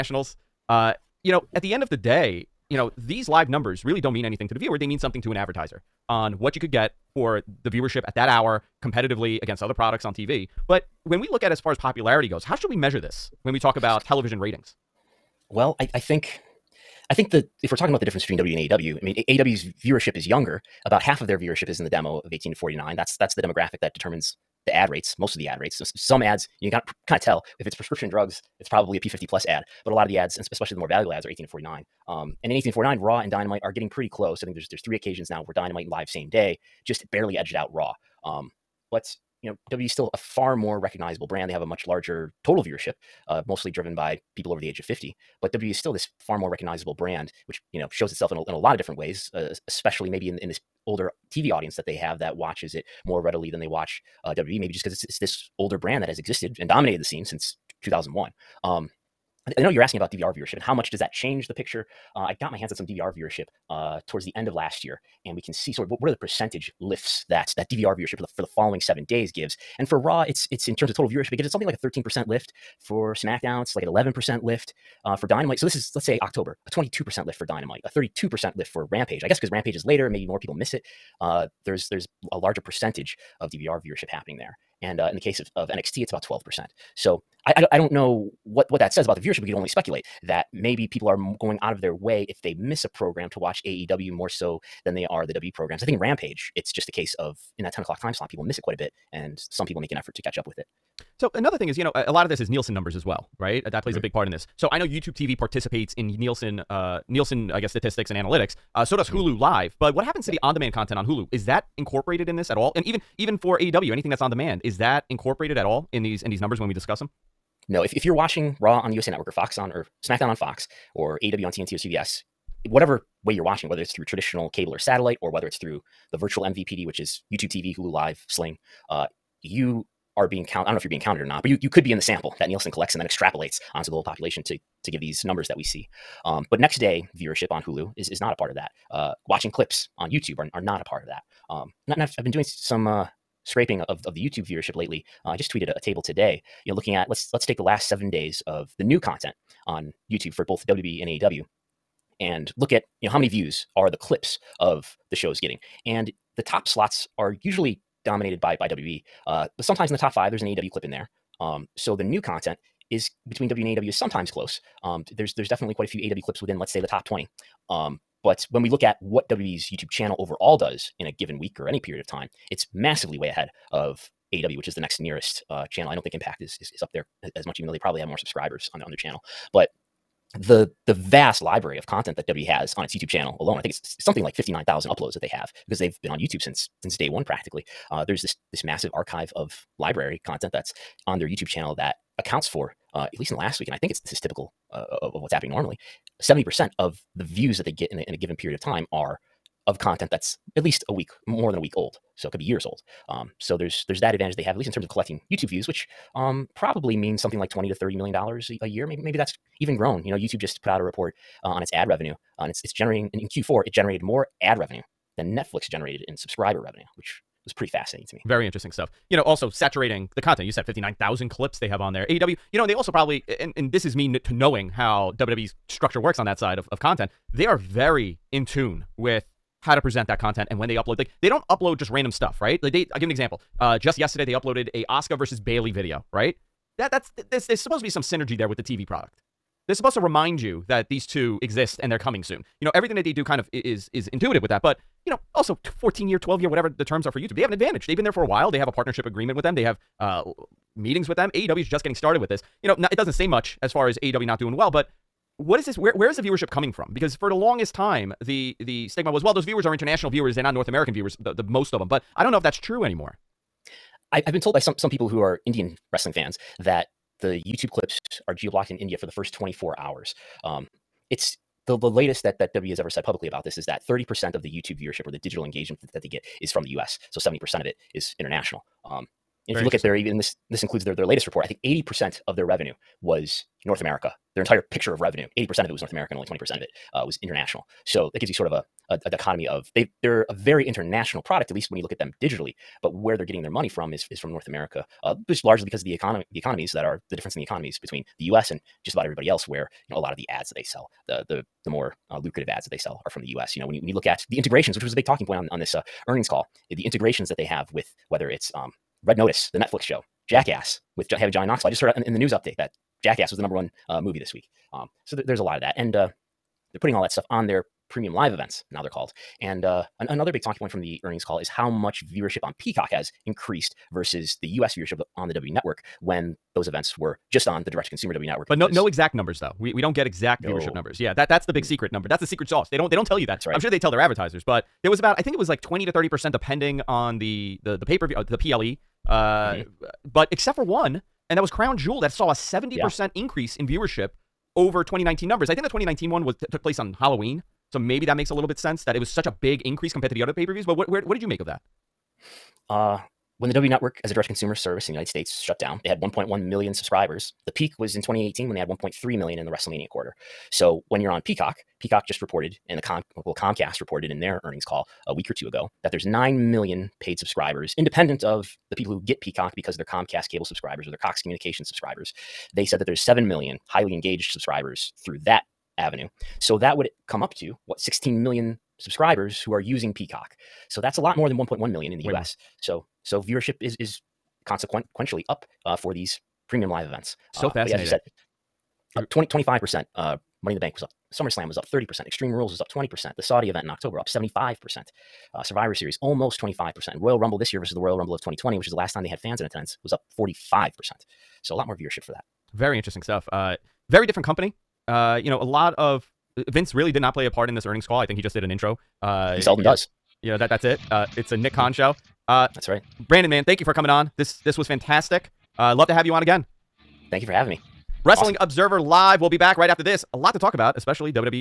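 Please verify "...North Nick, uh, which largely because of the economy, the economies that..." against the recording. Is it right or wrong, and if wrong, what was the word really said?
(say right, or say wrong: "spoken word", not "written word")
wrong: "America", not "Nick".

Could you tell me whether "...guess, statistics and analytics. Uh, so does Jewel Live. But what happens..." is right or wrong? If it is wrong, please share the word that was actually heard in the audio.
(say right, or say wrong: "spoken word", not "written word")
wrong: "Hulu", not "Jewel".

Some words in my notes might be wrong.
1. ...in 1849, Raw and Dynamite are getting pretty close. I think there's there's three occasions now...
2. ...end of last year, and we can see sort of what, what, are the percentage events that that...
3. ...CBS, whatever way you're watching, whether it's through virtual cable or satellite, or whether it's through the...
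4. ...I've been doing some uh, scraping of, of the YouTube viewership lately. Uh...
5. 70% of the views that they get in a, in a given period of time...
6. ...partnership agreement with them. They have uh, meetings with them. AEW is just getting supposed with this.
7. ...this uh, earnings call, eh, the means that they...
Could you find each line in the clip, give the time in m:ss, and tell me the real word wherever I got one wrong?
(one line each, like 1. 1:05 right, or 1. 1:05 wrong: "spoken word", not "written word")
1. 0:32 right
2. 1:04 wrong: "lifts", not "events"
3. 2:01 wrong: "traditional", not "virtual"
4. 2:22 right
5. 3:16 right
6. 4:08 wrong: "started", not "supposed"
7. 5:05 wrong: "integrations", not "means".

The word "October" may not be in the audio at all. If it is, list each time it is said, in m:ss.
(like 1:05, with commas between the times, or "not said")
1:16, 6:33.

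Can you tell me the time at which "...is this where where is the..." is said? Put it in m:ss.
4:15.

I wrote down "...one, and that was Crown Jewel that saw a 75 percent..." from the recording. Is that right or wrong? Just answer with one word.
wrong.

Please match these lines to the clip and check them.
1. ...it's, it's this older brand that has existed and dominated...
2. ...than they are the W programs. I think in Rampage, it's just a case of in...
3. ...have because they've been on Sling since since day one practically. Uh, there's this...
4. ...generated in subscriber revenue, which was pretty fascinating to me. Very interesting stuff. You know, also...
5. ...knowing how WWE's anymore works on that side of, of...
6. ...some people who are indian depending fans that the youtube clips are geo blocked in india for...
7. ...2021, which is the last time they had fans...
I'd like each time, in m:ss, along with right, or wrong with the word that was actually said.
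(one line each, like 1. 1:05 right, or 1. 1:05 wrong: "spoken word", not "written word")
1. 0:54 right
2. 1:34 right
3. 3:05 wrong: "YouTube", not "Sling"
4. 3:35 right
5. 3:44 wrong: "structure", not "anymore"
6. 4:24 wrong: "wrestling", not "depending"
7. 6:38 wrong: "2020", not "2021".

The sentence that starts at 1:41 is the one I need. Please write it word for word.
So another thing is, you know, a lot of this is Nielsen numbers as well right?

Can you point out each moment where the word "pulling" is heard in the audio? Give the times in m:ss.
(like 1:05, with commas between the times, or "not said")
not said.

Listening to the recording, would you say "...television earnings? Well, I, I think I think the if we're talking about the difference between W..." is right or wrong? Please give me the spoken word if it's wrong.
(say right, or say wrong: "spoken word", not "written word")
wrong: "ratings", not "earnings".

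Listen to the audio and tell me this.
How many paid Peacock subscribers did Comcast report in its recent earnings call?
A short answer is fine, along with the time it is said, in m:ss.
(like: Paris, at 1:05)
9 million, at 6:06.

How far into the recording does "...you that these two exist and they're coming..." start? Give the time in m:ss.
4:00.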